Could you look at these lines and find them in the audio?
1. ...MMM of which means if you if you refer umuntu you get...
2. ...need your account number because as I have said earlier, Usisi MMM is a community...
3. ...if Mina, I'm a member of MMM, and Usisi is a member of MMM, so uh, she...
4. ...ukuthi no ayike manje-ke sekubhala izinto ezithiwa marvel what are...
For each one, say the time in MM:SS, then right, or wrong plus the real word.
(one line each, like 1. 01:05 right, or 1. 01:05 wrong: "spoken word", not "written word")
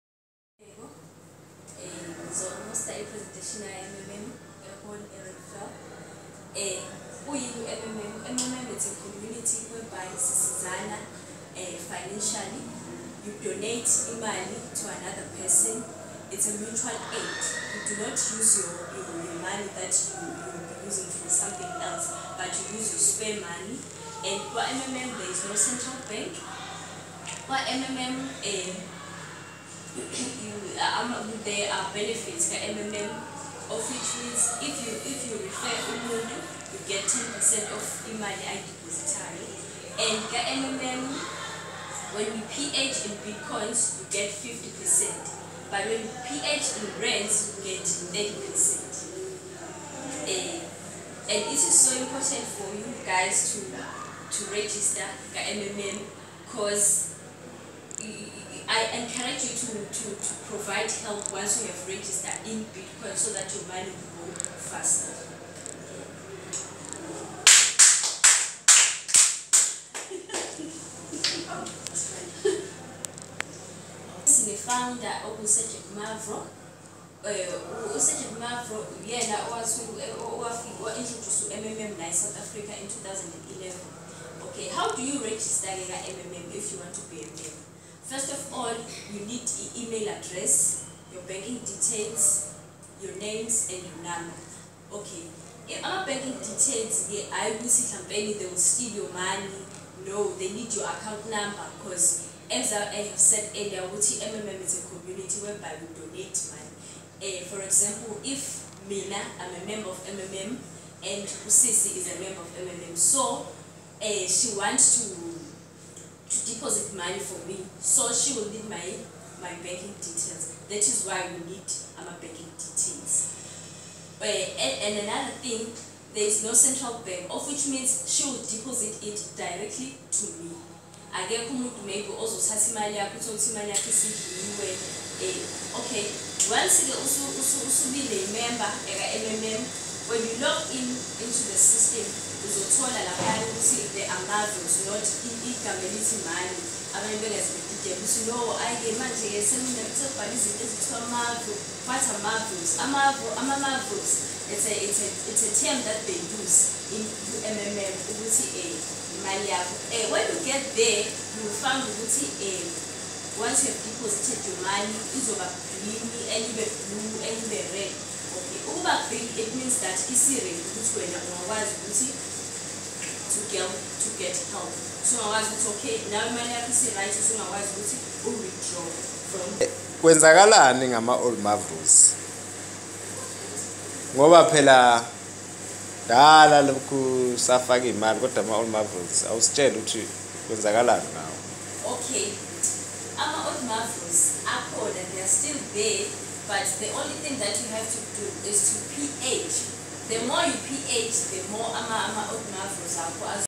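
1. 00:32 right
2. 01:40 wrong: "Wuti", not "Usisi"
3. 01:48 right
4. 02:27 right.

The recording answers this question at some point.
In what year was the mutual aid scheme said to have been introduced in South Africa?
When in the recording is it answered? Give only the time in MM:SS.
01:22.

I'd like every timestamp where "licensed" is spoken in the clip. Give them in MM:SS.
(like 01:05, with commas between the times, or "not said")
not said.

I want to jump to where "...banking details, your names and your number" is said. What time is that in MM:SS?
01:31.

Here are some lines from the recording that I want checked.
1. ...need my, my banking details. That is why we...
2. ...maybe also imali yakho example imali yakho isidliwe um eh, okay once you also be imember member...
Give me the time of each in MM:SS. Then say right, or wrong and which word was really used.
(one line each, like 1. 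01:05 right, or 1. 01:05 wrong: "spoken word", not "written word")
1. 01:58 right
2. 02:11 wrong: "uthole", not "example".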